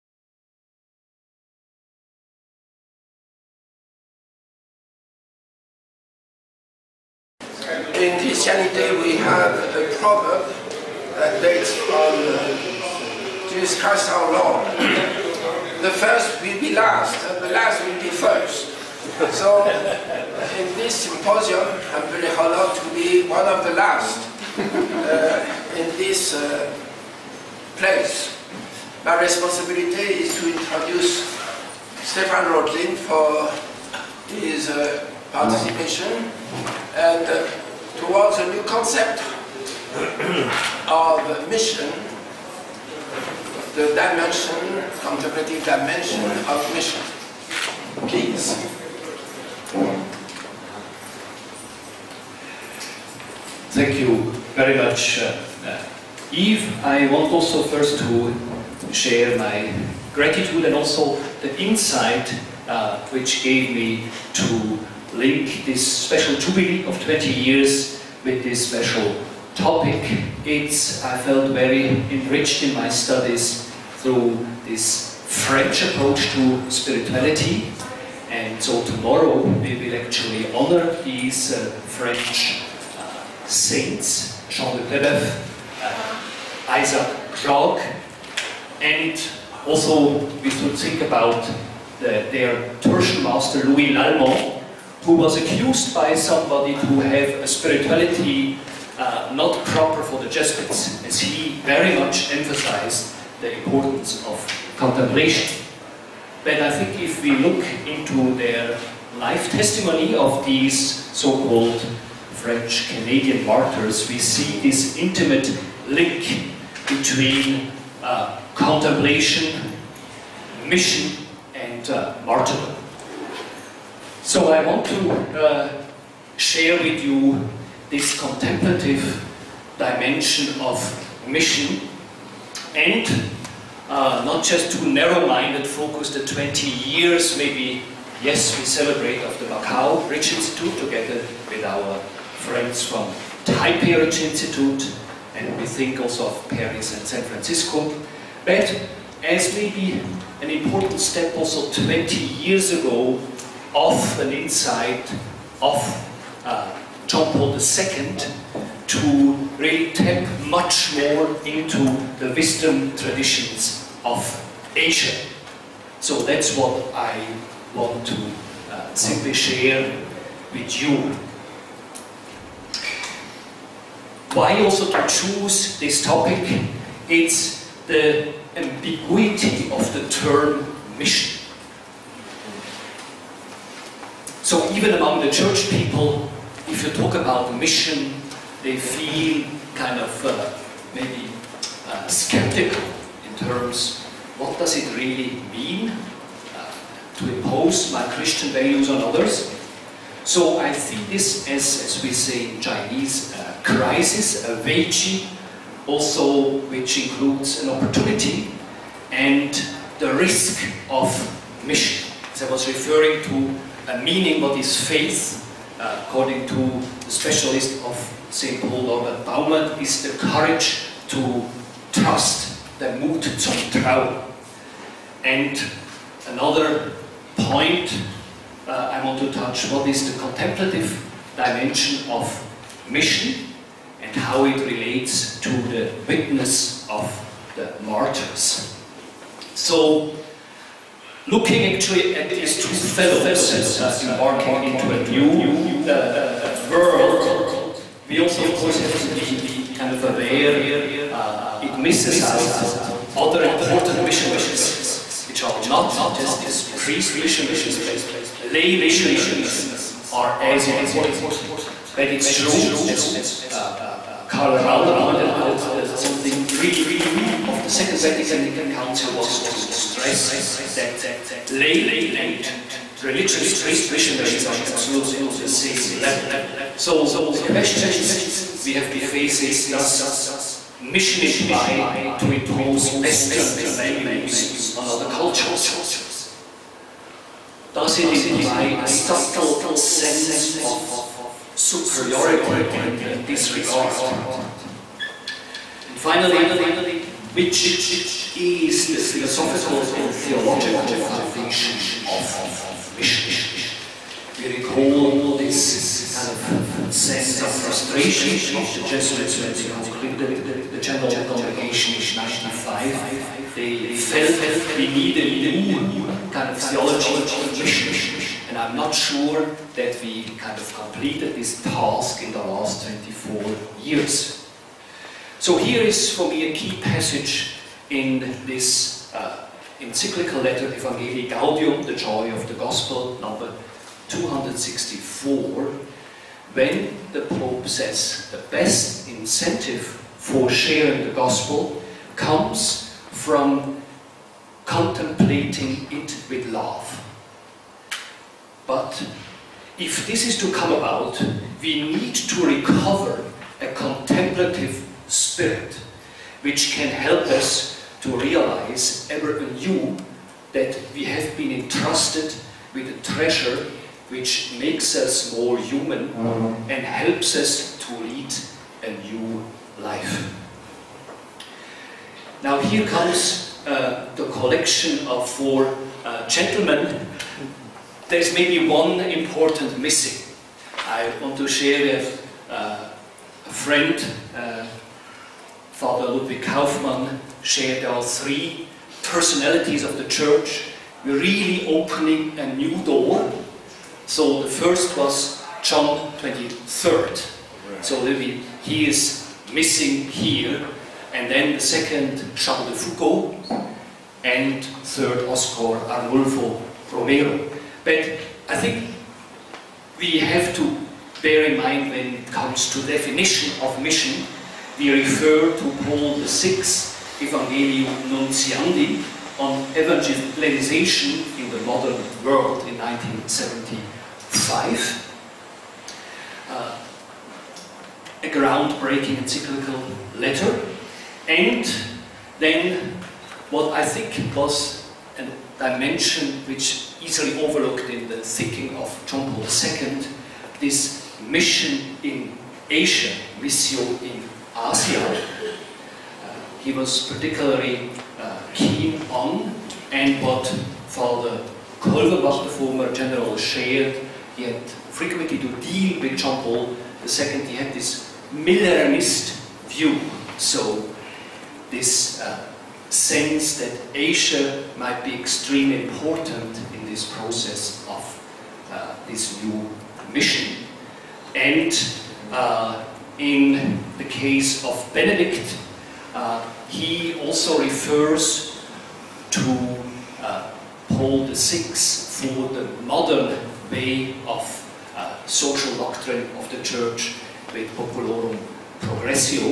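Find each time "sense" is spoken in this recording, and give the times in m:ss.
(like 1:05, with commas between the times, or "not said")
4:49, 5:06, 7:42.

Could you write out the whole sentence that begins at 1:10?
It's, I felt very enriched in my studies through this French approach to spirituality.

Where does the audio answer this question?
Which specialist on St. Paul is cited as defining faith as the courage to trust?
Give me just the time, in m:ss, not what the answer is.
3:38.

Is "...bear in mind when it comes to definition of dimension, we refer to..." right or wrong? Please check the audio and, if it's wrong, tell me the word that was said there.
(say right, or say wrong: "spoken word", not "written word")
wrong: "mission", not "dimension".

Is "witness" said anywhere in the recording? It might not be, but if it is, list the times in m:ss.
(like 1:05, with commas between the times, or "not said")
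3:56.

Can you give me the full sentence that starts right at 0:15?
the first will be last, and the last will be first.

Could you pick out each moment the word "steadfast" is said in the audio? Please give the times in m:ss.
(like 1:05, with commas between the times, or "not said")
not said.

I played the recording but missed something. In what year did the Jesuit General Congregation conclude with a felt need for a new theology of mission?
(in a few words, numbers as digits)
1995.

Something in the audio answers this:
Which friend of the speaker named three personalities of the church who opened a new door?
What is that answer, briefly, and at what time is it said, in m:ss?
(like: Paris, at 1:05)
Ludwig Kaufmann, at 6:26.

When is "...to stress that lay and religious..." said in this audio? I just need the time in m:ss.
4:29.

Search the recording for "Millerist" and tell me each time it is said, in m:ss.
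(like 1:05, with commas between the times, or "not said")
7:38.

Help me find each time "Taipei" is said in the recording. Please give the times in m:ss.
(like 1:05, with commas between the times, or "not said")
2:23.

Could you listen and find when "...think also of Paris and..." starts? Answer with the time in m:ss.
2:25.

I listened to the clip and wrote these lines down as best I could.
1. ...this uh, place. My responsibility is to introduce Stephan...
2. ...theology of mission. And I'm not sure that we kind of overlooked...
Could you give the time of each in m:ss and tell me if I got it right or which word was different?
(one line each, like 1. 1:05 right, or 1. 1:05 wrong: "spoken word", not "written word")
1. 0:25 right
2. 5:16 wrong: "completed", not "overlooked".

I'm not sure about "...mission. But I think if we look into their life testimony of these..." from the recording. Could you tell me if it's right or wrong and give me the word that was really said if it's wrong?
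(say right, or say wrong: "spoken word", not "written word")
wrong: "contemplation", not "mission".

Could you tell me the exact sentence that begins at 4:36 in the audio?
So the questions we have to face is, does mission imply to impose Western values on other cultures?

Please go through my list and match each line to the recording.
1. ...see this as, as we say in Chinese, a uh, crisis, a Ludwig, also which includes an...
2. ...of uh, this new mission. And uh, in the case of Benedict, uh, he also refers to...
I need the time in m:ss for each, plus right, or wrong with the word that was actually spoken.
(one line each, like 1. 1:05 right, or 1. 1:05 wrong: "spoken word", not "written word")
1. 3:20 wrong: "Weiji", not "Ludwig"
2. 7:47 right.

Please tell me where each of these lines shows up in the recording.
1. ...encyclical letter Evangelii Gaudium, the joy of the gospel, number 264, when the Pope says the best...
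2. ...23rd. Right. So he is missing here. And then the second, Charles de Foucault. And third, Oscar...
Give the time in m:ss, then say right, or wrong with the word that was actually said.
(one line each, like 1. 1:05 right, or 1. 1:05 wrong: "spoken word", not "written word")
1. 5:29 right
2. 6:36 right.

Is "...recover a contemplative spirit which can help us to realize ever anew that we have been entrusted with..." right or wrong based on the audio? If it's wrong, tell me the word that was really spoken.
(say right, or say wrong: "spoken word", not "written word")
right.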